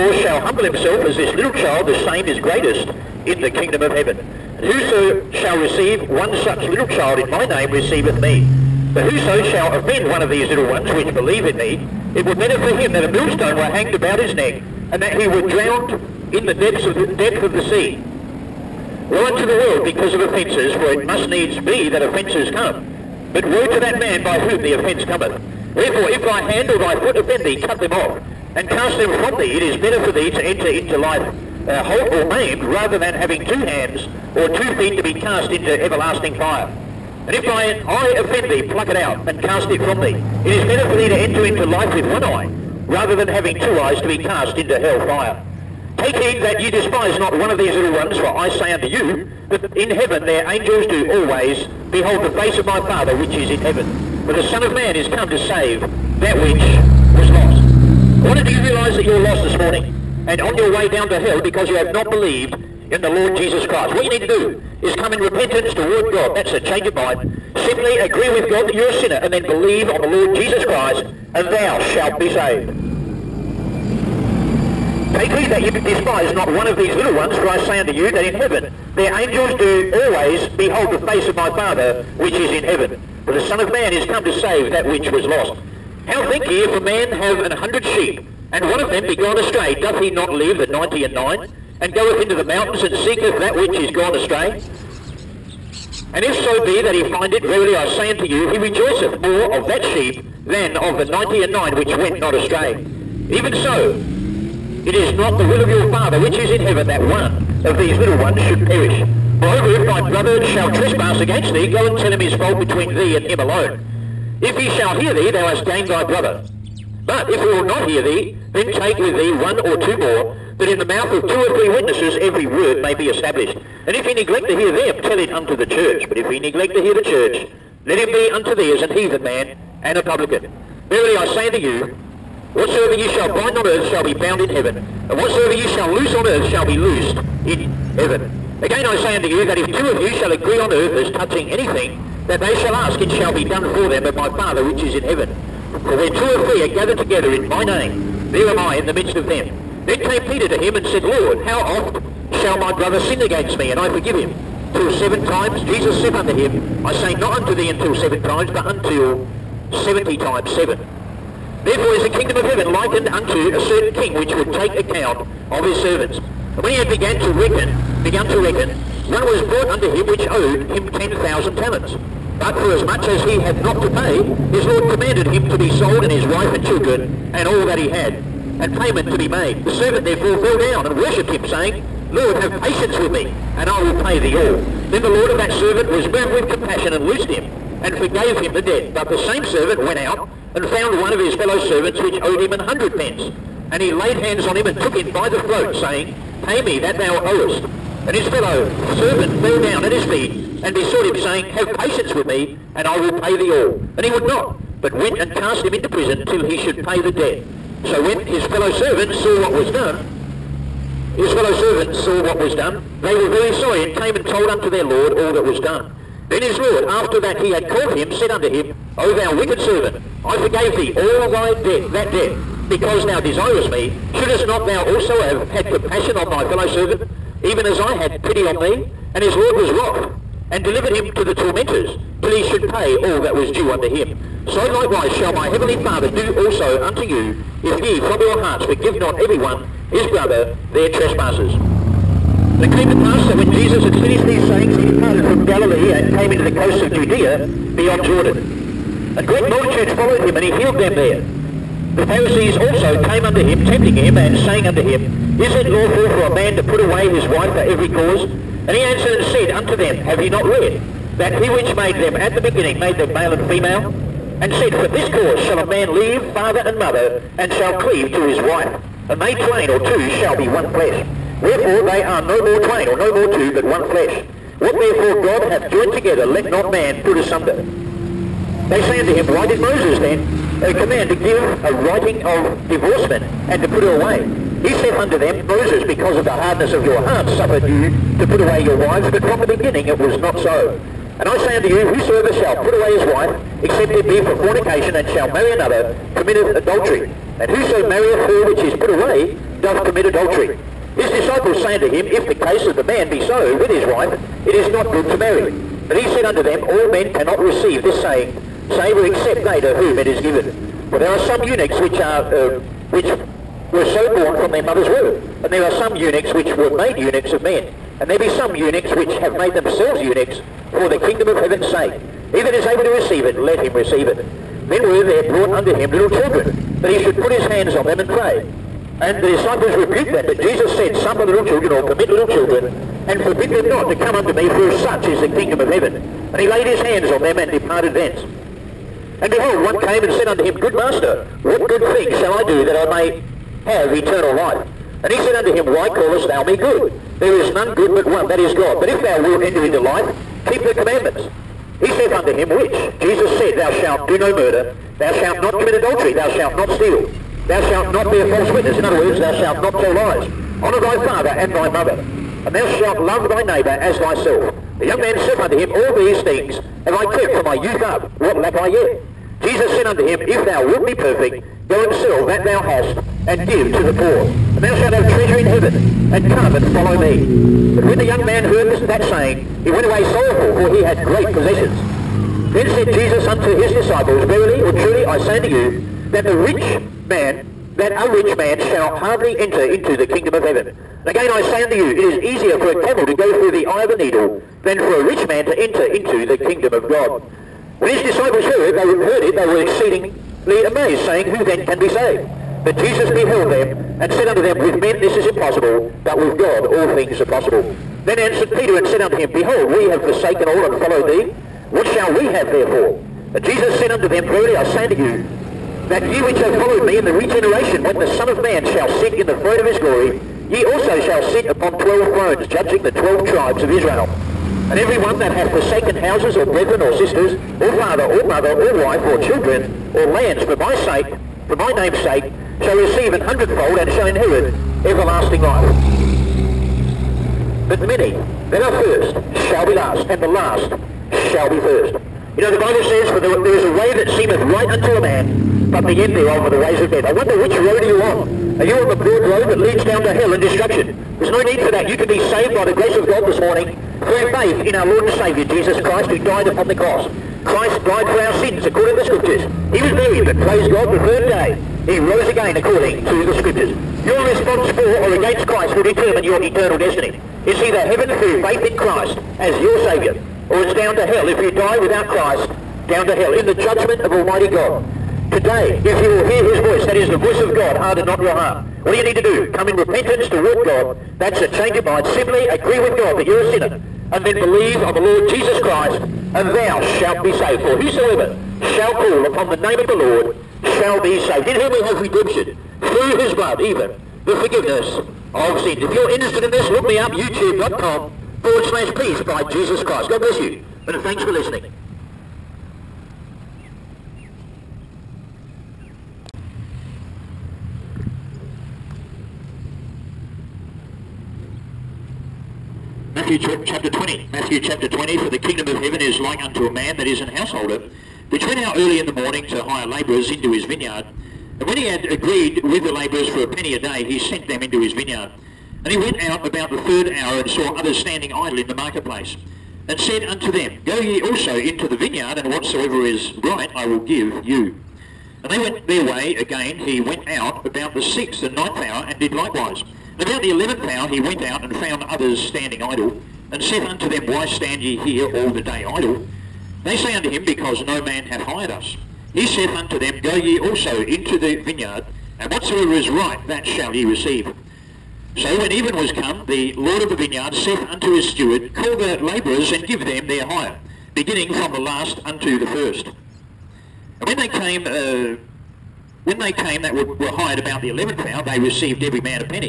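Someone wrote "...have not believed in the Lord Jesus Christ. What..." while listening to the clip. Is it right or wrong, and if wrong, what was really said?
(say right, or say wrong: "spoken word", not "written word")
right.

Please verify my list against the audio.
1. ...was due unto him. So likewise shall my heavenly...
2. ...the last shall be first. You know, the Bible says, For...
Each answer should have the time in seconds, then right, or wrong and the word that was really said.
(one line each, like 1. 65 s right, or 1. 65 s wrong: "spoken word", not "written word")
1. 233 s right
2. 440 s right.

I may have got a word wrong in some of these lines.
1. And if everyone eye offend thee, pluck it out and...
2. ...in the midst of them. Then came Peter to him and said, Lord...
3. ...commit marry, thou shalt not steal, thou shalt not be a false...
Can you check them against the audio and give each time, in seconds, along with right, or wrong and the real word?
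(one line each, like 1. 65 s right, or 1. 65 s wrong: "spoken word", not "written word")
1. 37 s wrong: "thine", not "everyone"
2. 148 s right
3. 355 s wrong: "adultery", not "marry".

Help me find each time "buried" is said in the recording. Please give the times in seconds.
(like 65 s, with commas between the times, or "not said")
459 s.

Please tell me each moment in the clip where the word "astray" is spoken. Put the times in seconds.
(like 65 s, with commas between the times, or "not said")
89 s, 94 s, 102 s.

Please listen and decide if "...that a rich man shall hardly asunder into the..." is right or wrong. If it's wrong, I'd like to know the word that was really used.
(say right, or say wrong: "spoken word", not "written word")
wrong: "enter", not "asunder".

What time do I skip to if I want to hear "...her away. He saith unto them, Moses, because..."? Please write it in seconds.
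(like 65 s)
283 s.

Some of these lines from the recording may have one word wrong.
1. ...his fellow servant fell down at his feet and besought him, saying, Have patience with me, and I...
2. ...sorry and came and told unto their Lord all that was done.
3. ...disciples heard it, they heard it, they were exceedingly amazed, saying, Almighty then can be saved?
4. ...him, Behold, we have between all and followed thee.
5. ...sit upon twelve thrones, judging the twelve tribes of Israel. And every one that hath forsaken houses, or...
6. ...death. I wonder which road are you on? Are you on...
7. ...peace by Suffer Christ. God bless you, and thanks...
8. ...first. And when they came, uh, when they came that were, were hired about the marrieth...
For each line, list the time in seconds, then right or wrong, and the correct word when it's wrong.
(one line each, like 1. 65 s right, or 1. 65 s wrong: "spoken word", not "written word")
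1. 198 s right
2. 213 s right
3. 398 s wrong: "Who", not "Almighty"
4. 409 s wrong: "forsaken", not "between"
5. 421 s right
6. 446 s right
7. 498 s wrong: "Jesus", not "Suffer"
8. 562 s wrong: "eleventh", not "marrieth".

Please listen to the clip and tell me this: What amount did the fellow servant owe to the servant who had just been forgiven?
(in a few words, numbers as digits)
100 pence.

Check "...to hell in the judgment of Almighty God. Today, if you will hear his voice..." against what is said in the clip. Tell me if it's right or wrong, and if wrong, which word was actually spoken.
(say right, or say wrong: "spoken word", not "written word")
right.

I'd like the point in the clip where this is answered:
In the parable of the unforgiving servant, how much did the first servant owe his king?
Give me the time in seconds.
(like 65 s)
170 s.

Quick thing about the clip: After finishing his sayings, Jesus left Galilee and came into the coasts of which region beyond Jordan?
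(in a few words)
Judea.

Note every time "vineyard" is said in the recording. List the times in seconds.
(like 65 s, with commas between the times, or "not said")
520 s, 524 s, 531 s, 551 s, 557 s.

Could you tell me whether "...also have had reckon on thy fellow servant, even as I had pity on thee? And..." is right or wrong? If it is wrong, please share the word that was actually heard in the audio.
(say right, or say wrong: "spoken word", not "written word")
wrong: "compassion", not "reckon".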